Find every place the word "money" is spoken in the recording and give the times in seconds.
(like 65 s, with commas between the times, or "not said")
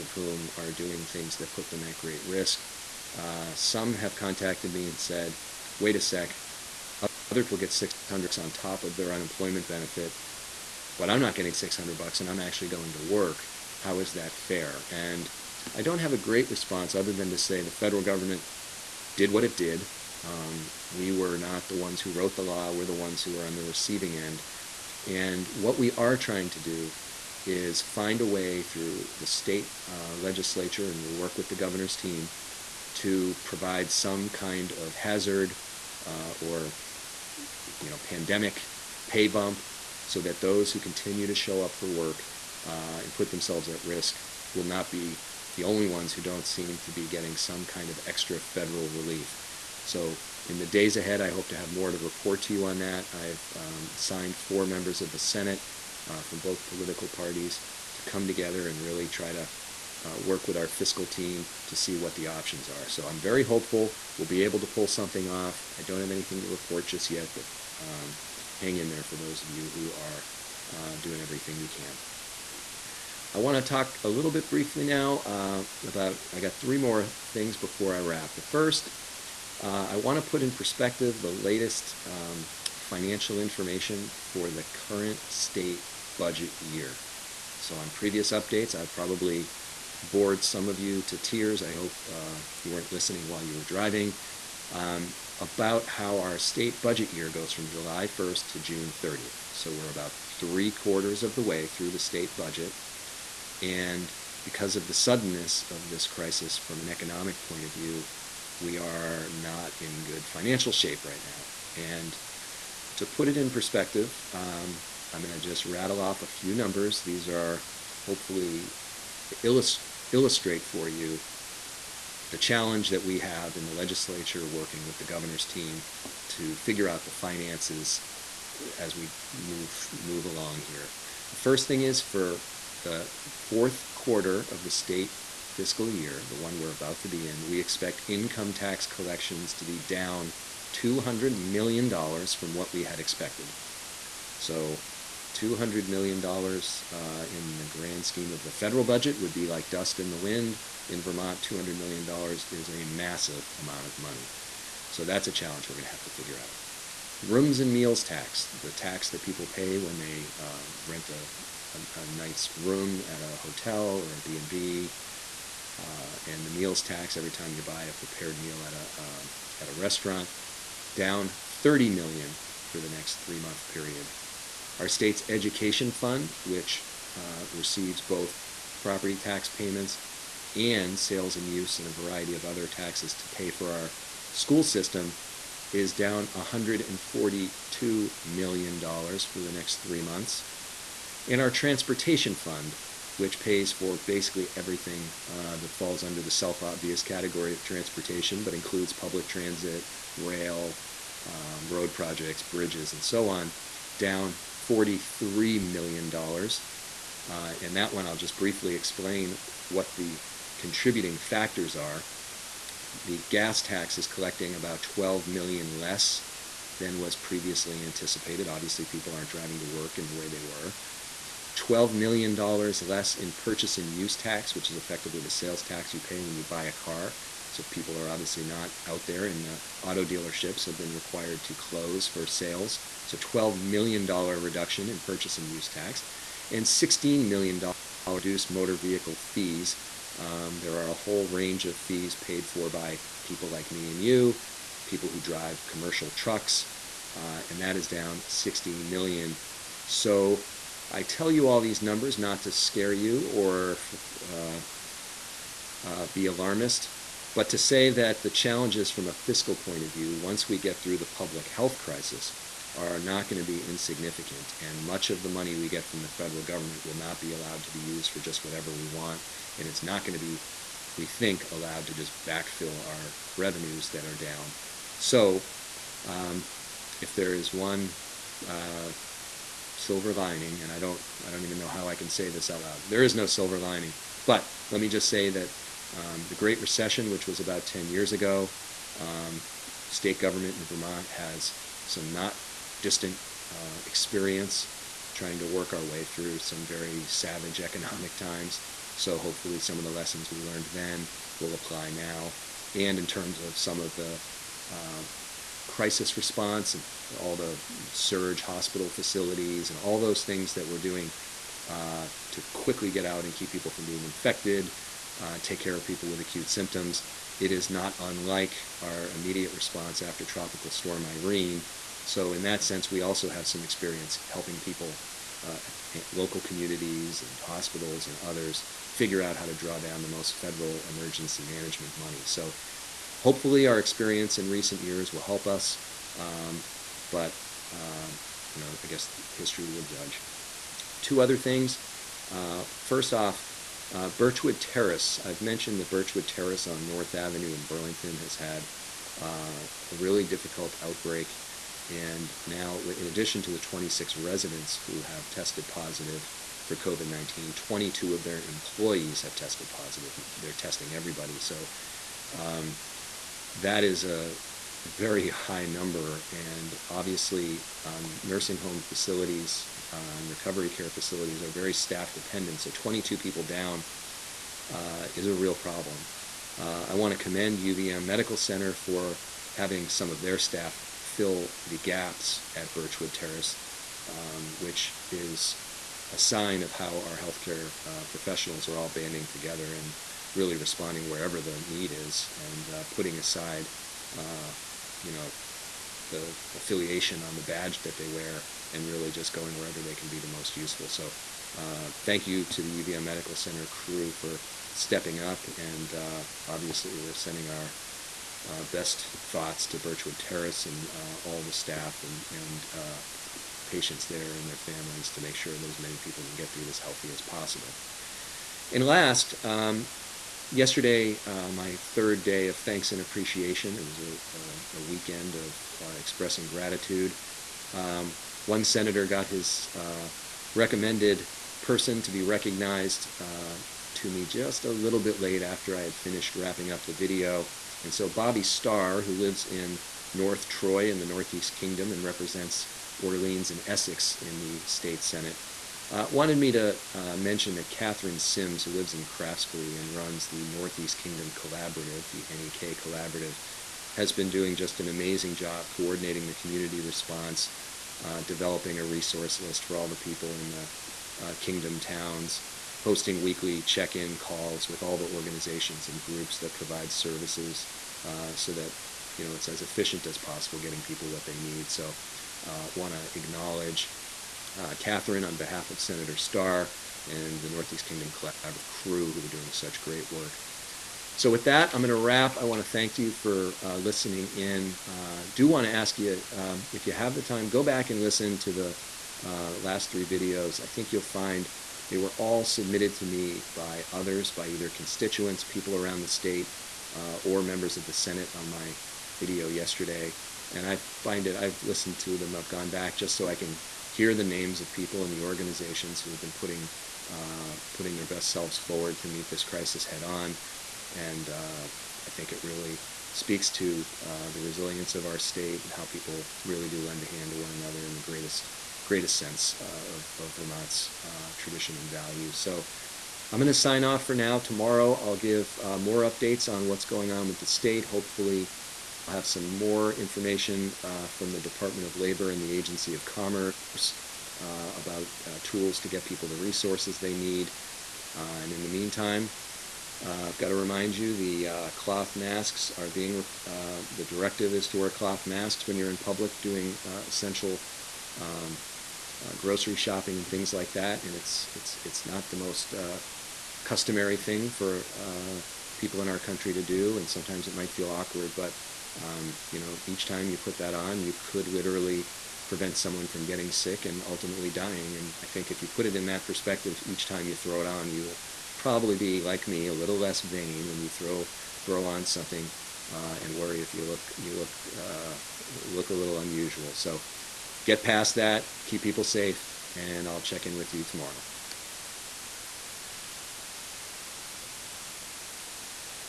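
153 s, 265 s, 331 s.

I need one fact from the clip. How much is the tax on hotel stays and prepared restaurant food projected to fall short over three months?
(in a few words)
30 million.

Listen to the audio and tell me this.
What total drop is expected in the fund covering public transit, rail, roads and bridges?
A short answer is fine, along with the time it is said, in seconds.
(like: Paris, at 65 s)
$43 million, at 204 s.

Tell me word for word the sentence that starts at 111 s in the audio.
And to put it in perspective, um, I'm going to just rattle off a few numbers.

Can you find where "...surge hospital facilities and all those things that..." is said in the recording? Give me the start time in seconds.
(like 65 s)
307 s.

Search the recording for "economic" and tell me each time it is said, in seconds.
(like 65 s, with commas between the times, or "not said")
106 s, 297 s.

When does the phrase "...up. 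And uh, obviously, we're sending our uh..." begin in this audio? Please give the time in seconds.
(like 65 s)
405 s.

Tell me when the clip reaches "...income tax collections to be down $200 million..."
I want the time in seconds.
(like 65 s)
138 s.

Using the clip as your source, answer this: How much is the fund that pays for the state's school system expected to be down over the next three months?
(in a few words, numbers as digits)
$142 million.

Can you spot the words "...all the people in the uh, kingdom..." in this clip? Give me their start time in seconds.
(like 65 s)
459 s.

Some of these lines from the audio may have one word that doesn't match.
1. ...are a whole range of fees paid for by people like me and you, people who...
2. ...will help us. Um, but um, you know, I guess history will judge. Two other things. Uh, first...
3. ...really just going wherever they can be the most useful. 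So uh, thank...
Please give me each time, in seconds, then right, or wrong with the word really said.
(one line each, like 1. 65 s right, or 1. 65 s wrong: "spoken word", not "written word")
1. 240 s right
2. 335 s right
3. 398 s right.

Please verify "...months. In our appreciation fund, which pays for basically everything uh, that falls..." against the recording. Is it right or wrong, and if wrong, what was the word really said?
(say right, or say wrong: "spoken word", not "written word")
wrong: "transportation", not "appreciation".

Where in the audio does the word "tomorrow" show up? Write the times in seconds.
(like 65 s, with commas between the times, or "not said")
524 s, 580 s.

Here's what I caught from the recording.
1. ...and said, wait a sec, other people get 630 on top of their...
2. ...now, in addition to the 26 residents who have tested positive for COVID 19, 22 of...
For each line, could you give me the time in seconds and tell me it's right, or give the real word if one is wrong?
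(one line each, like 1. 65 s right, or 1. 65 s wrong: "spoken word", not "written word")
1. 4 s wrong: "600", not "630"
2. 352 s right.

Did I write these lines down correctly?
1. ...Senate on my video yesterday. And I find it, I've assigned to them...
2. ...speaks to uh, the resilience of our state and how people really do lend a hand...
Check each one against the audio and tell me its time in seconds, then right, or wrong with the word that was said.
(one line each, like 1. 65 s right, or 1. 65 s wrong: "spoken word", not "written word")
1. 497 s wrong: "listened", not "assigned"
2. 513 s right.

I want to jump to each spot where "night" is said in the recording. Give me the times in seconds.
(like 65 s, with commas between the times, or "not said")
162 s.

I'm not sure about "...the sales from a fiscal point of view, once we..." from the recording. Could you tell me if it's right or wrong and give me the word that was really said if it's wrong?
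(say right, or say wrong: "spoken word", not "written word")
wrong: "challenges", not "sales".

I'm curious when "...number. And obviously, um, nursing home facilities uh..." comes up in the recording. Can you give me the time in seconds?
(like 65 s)
365 s.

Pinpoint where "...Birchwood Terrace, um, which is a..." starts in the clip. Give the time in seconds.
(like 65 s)
382 s.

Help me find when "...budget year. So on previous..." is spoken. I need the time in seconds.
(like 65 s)
86 s.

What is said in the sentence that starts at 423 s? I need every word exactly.
It was a, a weekend of uh, expressing gratitude.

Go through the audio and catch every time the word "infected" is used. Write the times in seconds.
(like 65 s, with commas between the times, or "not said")
314 s.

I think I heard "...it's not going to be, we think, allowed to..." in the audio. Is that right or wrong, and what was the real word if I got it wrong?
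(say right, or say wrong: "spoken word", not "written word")
right.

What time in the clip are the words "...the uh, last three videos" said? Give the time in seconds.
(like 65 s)
488 s.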